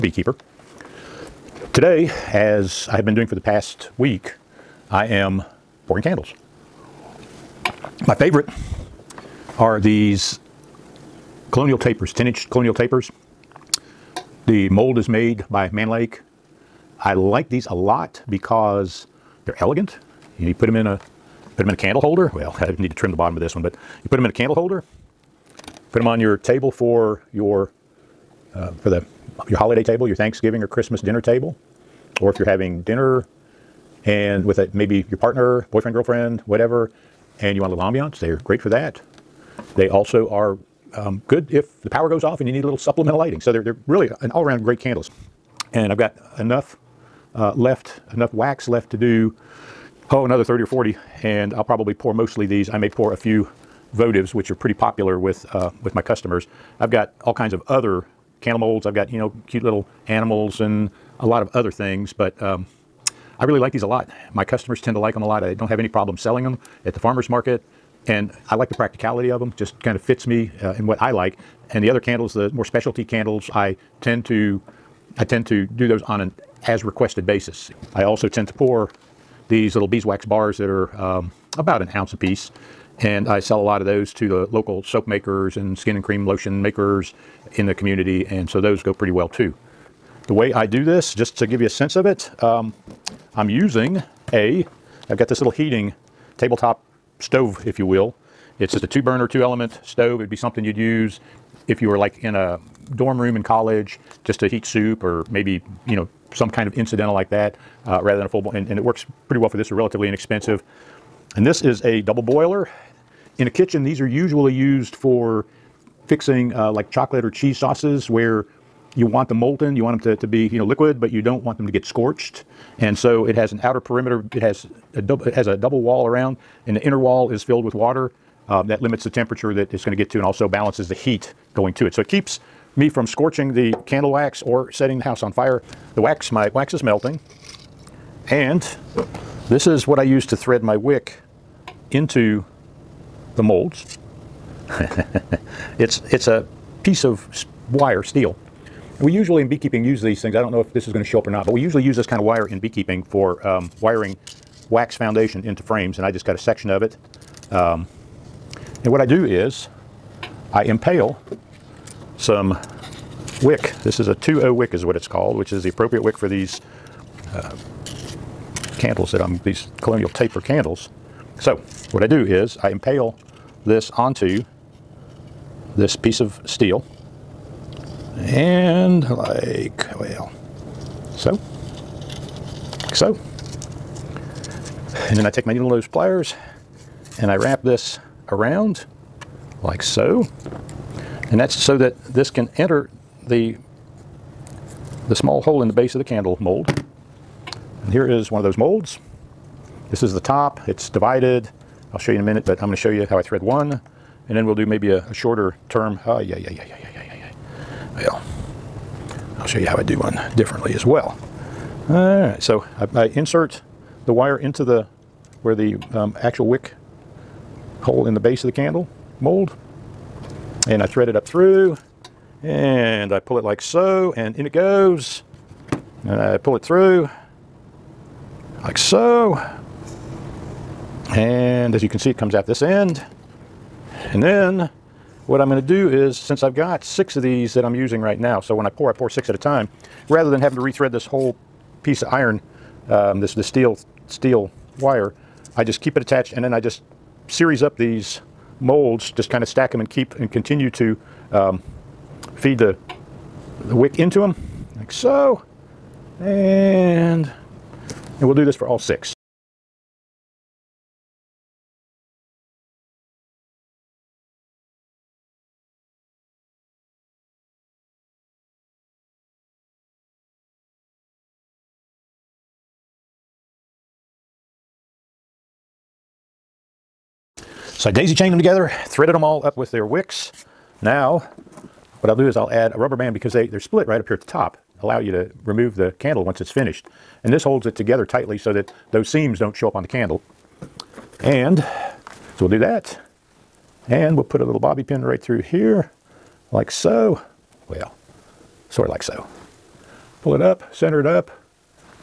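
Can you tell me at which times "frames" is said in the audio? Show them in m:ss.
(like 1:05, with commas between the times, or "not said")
2:35.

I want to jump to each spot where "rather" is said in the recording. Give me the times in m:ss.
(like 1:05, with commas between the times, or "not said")
1:48, 4:00.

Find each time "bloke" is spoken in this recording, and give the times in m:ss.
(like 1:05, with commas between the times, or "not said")
not said.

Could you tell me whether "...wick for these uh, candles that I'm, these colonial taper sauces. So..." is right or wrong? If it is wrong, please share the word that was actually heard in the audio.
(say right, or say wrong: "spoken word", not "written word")
wrong: "candles", not "sauces".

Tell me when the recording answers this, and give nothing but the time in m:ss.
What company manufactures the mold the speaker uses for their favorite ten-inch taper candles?
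0:15.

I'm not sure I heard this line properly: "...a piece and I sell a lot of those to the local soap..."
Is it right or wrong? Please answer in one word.
right.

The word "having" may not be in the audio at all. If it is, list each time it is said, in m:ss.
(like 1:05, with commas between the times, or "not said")
0:32, 4:00.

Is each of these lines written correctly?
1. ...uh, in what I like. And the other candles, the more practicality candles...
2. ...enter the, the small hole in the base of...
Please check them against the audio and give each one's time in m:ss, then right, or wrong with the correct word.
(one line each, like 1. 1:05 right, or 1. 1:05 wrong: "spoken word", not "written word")
1. 1:10 wrong: "specialty", not "practicality"
2. 3:12 right.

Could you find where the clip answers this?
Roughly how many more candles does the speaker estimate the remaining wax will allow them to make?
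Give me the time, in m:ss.
0:50.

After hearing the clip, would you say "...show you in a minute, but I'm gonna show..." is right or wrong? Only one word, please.
right.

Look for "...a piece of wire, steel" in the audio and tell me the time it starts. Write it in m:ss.
2:26.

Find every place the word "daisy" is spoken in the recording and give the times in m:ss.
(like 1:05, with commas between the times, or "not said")
4:37.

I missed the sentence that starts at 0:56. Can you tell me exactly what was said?
I've got all kinds of other candle molds.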